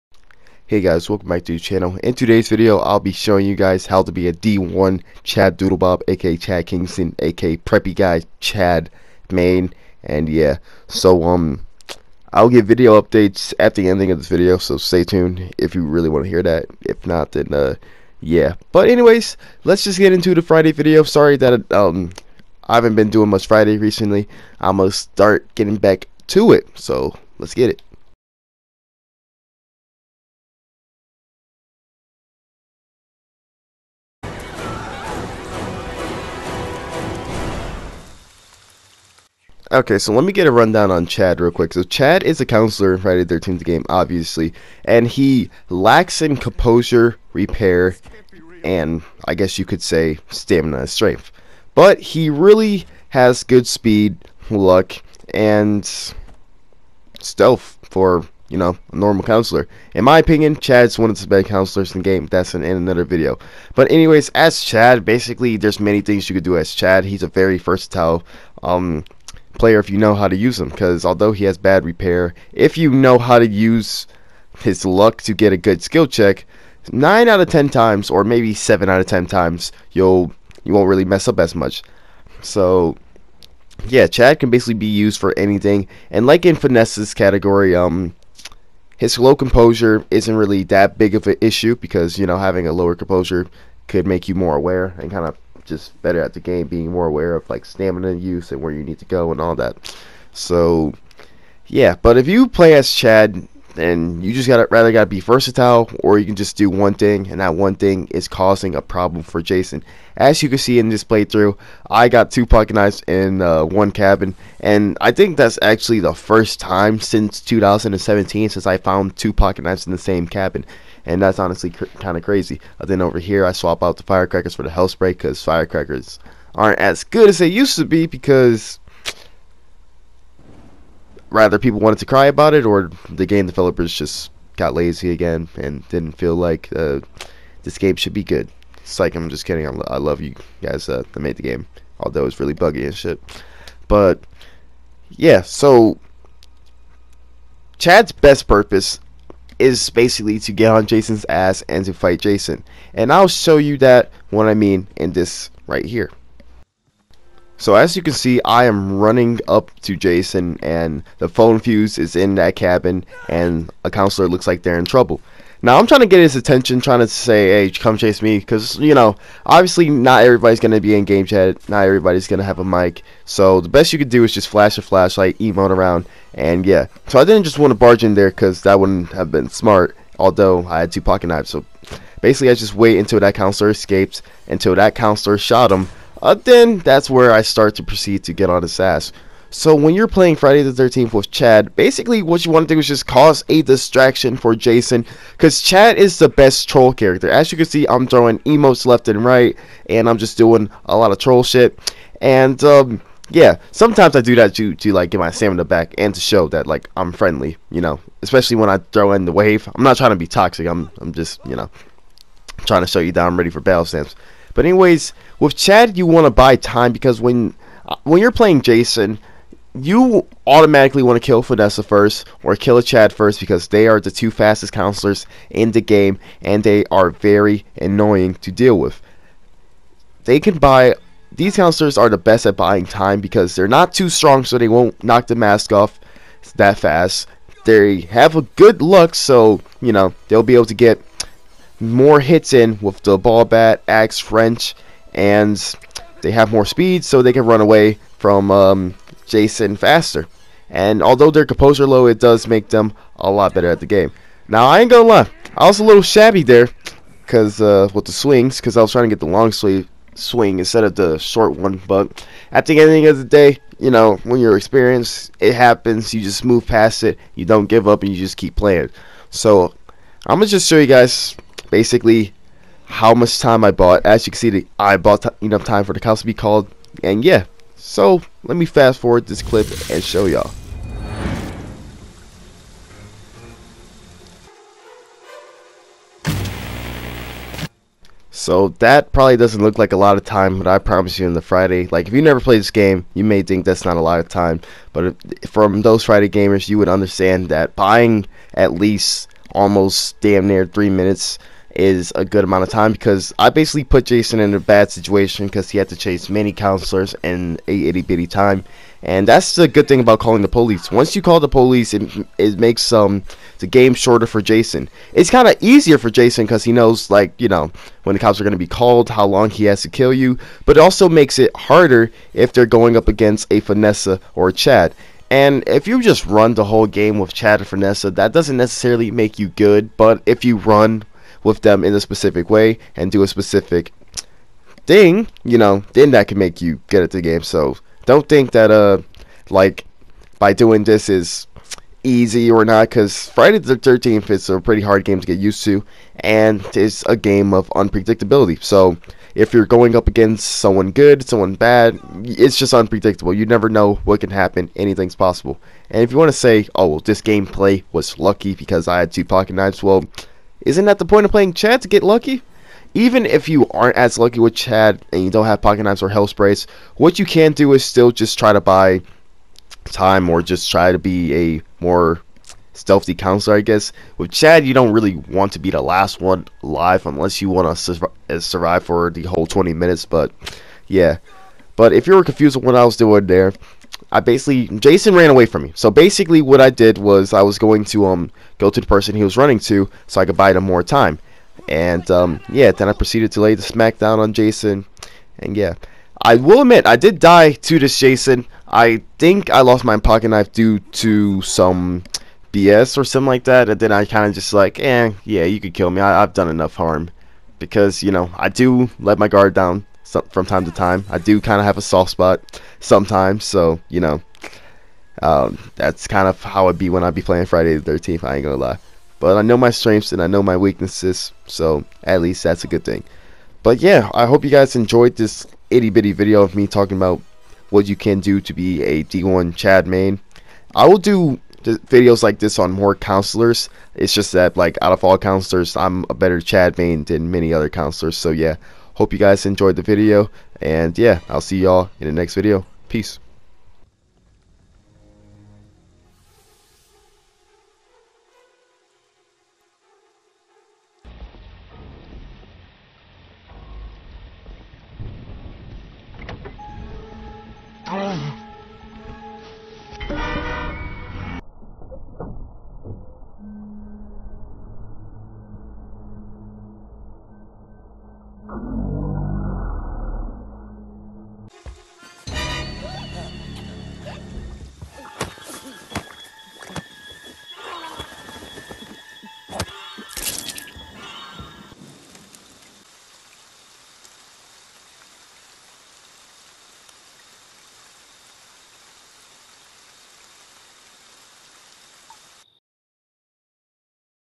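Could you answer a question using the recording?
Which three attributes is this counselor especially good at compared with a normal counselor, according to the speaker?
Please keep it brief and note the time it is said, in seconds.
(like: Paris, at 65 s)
Speed, luck, and stealth, at 53 s.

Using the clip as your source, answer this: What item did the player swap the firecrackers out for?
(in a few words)
Hell spray.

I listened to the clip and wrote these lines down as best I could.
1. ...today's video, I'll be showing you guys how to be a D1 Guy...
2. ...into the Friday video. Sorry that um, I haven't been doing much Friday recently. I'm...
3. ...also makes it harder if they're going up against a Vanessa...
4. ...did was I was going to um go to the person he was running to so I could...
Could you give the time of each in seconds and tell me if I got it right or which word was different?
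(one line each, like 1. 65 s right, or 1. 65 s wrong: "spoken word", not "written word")
1. 2 s wrong: "Chad", not "Guy"
2. 20 s right
3. 320 s right
4. 386 s right.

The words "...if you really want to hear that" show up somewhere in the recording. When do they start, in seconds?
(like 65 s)
15 s.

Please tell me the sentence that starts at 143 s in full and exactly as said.
But yeah, so Chad's best purpose is basically to get on Jason's ass and to fight Jason.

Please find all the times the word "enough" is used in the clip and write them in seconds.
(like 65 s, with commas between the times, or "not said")
275 s, 406 s.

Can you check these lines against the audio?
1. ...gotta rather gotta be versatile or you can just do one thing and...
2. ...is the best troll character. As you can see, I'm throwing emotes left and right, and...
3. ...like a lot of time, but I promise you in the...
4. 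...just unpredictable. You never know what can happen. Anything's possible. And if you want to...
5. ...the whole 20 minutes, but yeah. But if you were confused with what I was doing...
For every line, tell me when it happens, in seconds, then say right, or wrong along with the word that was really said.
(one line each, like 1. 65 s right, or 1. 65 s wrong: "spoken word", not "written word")
1. 104 s right
2. 195 s right
3. 289 s right
4. 352 s right
5. 379 s right.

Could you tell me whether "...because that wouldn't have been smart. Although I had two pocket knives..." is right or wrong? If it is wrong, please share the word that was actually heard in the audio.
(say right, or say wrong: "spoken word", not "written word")
right.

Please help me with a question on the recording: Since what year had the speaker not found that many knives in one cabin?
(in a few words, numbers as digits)
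2017.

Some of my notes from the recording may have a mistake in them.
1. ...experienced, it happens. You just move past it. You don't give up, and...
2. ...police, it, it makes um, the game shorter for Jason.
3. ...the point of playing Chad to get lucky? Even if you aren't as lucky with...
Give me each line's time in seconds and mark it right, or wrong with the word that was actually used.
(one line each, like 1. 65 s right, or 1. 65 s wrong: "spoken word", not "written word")
1. 264 s right
2. 311 s right
3. 360 s right.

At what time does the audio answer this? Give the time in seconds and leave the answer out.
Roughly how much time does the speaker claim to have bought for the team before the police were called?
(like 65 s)
300 s.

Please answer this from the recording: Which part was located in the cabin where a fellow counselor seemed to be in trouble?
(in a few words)
Phone fuse.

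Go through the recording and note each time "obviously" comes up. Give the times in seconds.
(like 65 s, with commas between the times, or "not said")
43 s, 169 s.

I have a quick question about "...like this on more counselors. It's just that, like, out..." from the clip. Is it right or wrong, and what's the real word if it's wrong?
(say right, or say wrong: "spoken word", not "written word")
right.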